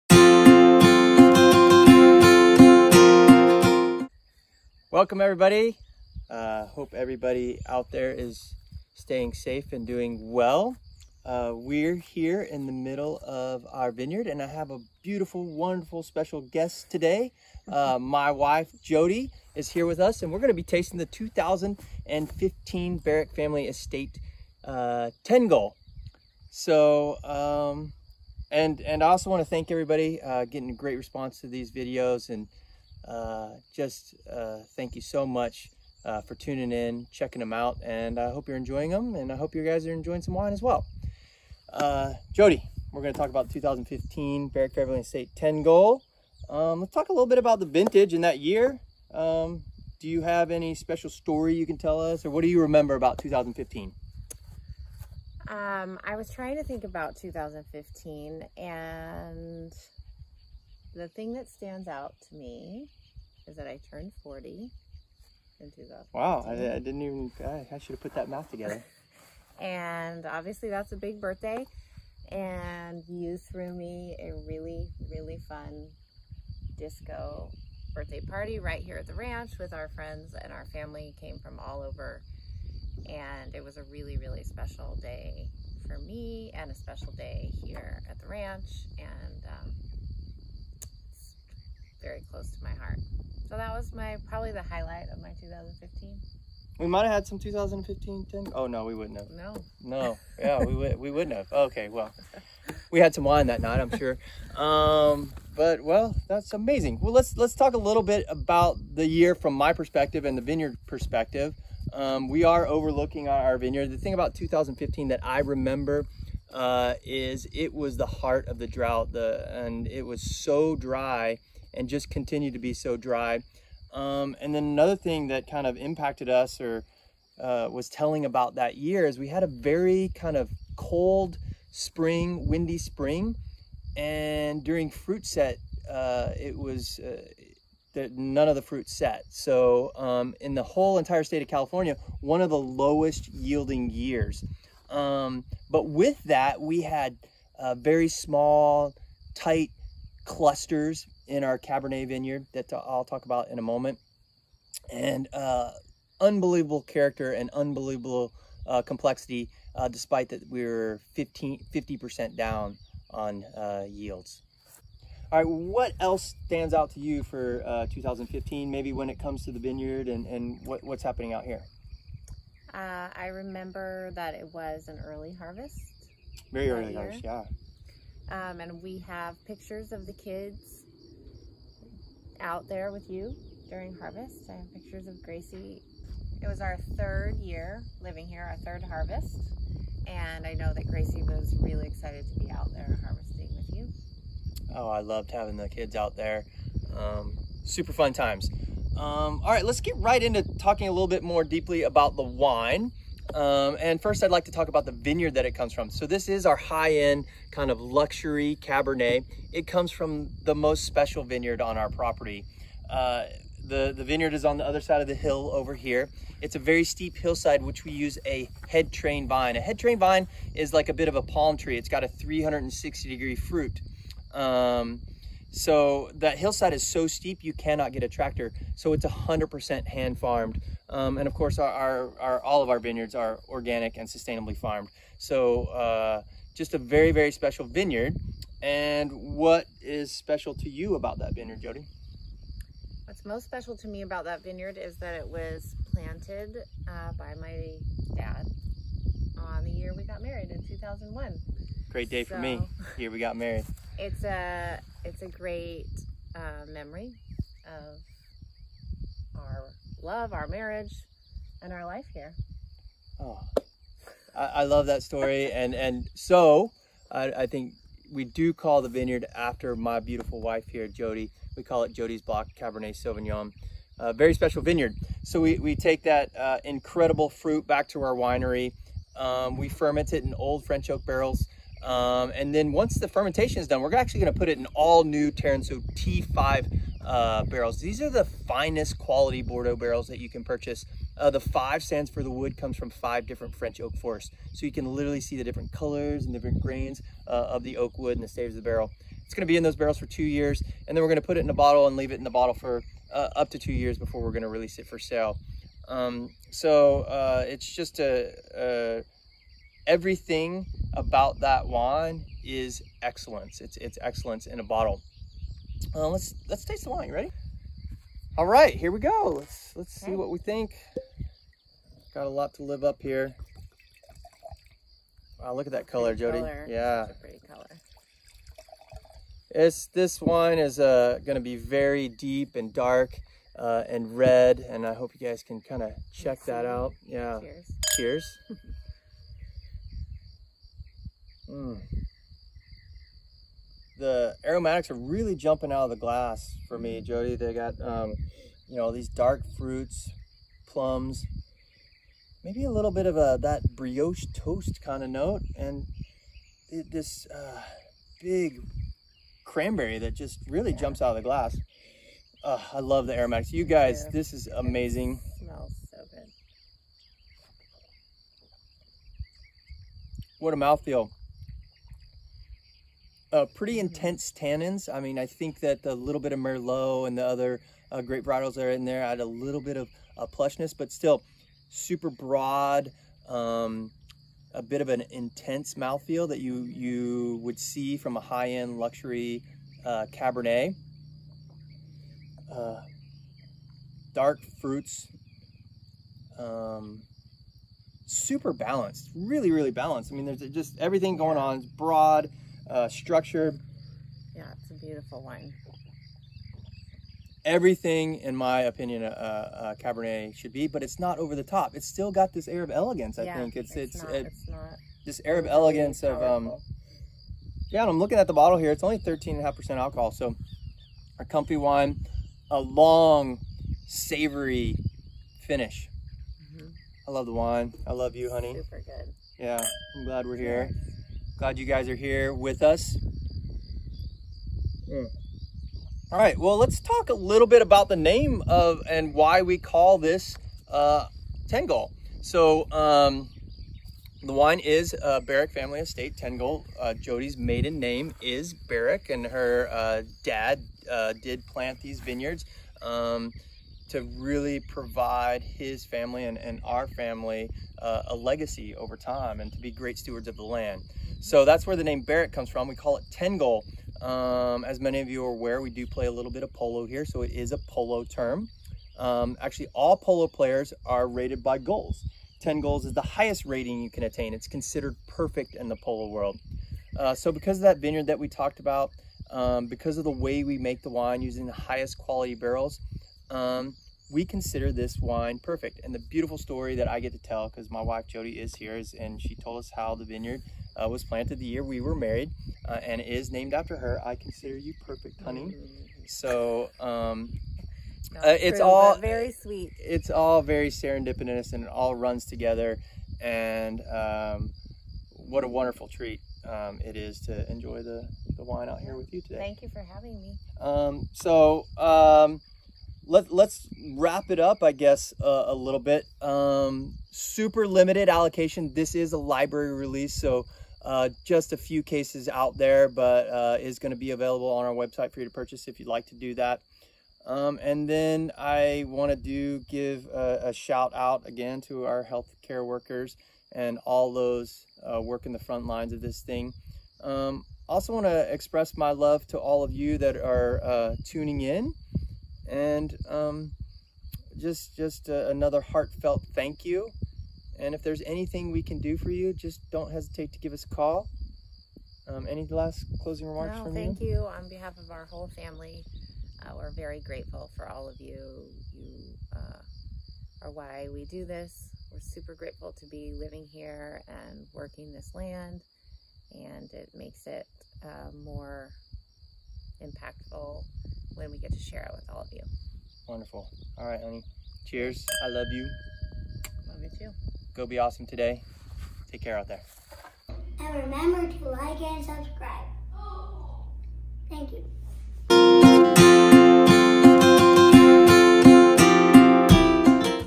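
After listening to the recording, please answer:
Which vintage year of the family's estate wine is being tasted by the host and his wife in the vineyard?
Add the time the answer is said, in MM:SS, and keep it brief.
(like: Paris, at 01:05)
2015, at 00:21.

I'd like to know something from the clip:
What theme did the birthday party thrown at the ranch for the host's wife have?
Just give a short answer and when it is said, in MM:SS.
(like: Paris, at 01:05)
Disco, at 01:16.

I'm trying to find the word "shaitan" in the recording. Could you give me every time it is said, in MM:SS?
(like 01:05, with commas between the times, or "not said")
not said.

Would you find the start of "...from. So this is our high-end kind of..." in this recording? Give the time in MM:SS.
03:25.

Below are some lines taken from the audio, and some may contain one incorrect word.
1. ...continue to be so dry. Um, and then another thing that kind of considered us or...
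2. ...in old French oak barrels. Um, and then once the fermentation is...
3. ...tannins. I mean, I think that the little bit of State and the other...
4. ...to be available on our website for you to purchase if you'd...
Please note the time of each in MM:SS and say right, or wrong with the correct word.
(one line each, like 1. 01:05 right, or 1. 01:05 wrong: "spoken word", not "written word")
1. 02:02 wrong: "impacted", not "considered"
2. 04:40 right
3. 06:14 wrong: "Merlot", not "State"
4. 08:43 right.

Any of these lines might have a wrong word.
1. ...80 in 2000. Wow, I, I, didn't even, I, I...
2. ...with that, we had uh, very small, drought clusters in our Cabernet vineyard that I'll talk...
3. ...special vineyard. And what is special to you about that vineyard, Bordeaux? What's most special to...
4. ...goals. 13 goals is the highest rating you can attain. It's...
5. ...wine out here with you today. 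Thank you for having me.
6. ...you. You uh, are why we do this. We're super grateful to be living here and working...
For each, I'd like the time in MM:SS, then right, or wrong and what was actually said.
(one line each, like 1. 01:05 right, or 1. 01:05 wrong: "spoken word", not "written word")
1. 01:04 wrong: "40", not "80"
2. 02:25 wrong: "tight", not "drought"
3. 03:57 wrong: "Jodi", not "Bordeaux"
4. 07:51 wrong: "10", not "13"
5. 08:28 right
6. 09:18 right.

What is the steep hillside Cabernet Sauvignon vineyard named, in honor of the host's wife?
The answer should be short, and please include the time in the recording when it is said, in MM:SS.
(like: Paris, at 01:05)
Jodi's Block, at 04:31.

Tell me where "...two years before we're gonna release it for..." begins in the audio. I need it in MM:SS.
05:03.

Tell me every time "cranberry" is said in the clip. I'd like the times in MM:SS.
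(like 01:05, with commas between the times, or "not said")
05:59.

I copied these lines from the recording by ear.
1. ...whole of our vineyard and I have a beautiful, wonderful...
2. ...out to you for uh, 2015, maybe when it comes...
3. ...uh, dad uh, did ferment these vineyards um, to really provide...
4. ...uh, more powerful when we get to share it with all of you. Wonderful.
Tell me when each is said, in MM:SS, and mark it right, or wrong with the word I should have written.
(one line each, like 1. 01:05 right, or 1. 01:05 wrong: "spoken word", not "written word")
1. 00:12 wrong: "middle", not "whole"
2. 02:46 right
3. 07:29 wrong: "plant", not "ferment"
4. 09:27 wrong: "impactful", not "powerful".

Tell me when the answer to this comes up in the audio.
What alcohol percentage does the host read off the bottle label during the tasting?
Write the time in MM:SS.
06:58.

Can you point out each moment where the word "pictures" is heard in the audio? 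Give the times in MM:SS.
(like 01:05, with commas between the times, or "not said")
02:59, 03:04.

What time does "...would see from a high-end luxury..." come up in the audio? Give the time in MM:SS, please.
06:27.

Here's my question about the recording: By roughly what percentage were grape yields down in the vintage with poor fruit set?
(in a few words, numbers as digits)
50%.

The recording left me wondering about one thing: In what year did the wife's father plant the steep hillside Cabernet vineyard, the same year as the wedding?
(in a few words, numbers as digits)
2001.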